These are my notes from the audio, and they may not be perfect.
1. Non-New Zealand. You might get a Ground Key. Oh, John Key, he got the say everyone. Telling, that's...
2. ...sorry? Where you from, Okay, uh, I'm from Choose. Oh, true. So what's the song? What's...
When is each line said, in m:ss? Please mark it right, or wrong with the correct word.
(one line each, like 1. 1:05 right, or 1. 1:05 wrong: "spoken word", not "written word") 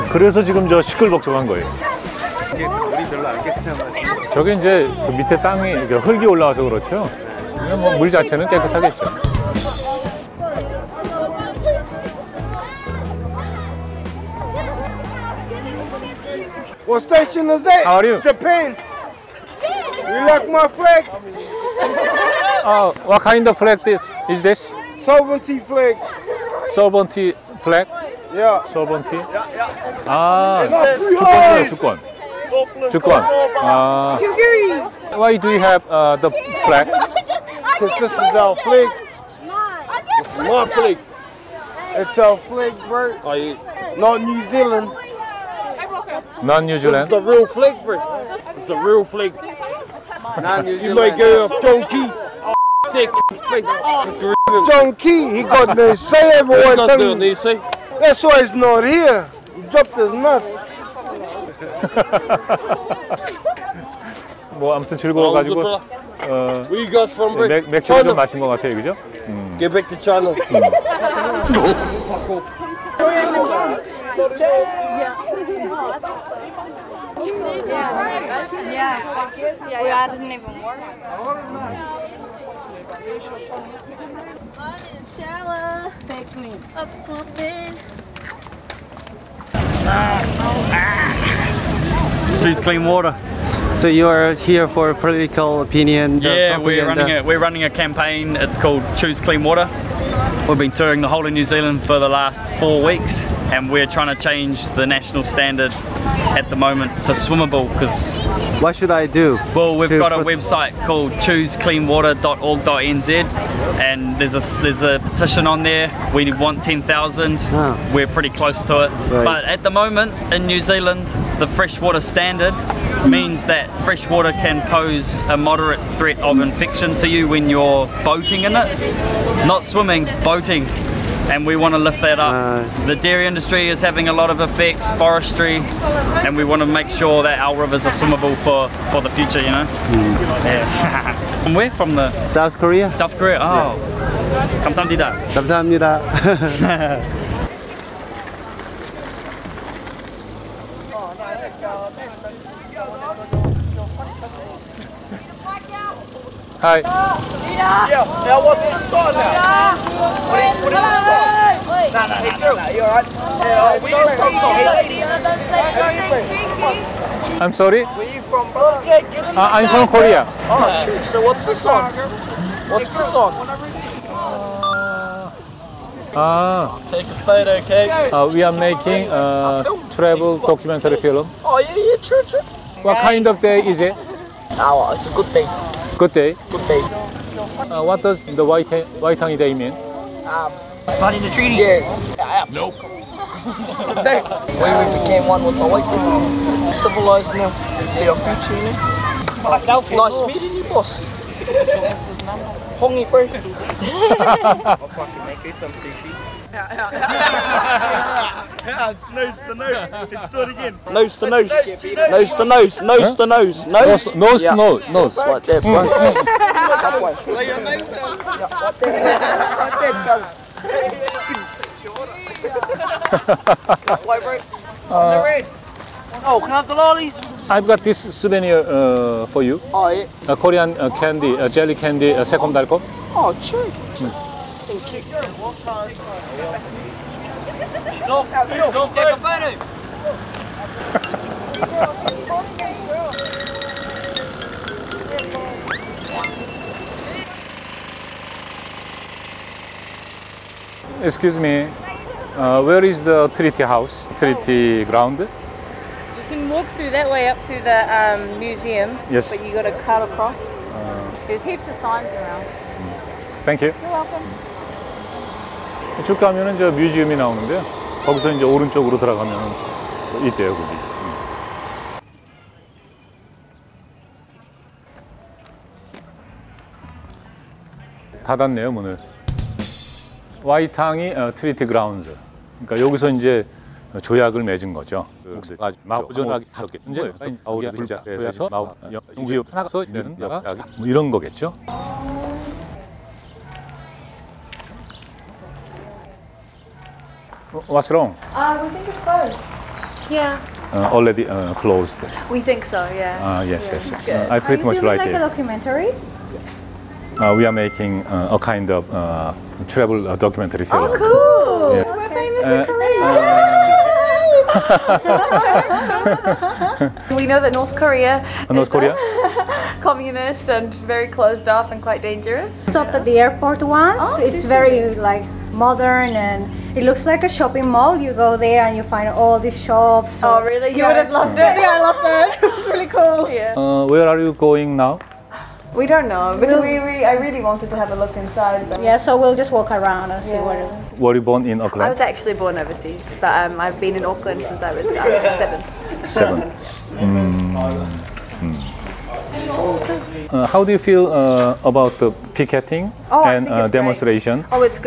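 1. 0:50 wrong: "John", not "Ground"
2. 2:47 wrong: "Korea", not "Choose".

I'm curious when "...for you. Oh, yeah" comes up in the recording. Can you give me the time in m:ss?
3:49.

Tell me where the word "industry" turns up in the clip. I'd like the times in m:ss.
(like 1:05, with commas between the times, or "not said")
2:13.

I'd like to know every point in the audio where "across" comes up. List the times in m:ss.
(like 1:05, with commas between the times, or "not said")
4:20.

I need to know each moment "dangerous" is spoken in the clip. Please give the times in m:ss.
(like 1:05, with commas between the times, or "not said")
5:21.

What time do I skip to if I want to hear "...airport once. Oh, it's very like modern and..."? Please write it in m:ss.
5:23.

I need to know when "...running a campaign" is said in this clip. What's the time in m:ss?
1:37.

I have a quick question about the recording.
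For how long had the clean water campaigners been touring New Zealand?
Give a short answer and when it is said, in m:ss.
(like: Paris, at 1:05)
4 weeks, at 1:42.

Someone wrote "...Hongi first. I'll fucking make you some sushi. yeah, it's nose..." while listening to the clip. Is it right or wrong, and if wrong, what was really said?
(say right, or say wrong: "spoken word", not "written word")
right.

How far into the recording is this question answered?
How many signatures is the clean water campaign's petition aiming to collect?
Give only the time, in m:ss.
1:56.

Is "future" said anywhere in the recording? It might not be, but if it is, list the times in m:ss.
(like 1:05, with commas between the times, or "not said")
2:19, 3:18.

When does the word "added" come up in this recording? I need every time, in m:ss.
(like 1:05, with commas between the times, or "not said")
1:19.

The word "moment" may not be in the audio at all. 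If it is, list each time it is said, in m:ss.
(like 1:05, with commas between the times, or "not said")
1:46, 1:59.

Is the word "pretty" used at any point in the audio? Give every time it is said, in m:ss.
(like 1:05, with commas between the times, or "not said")
1:58, 5:04.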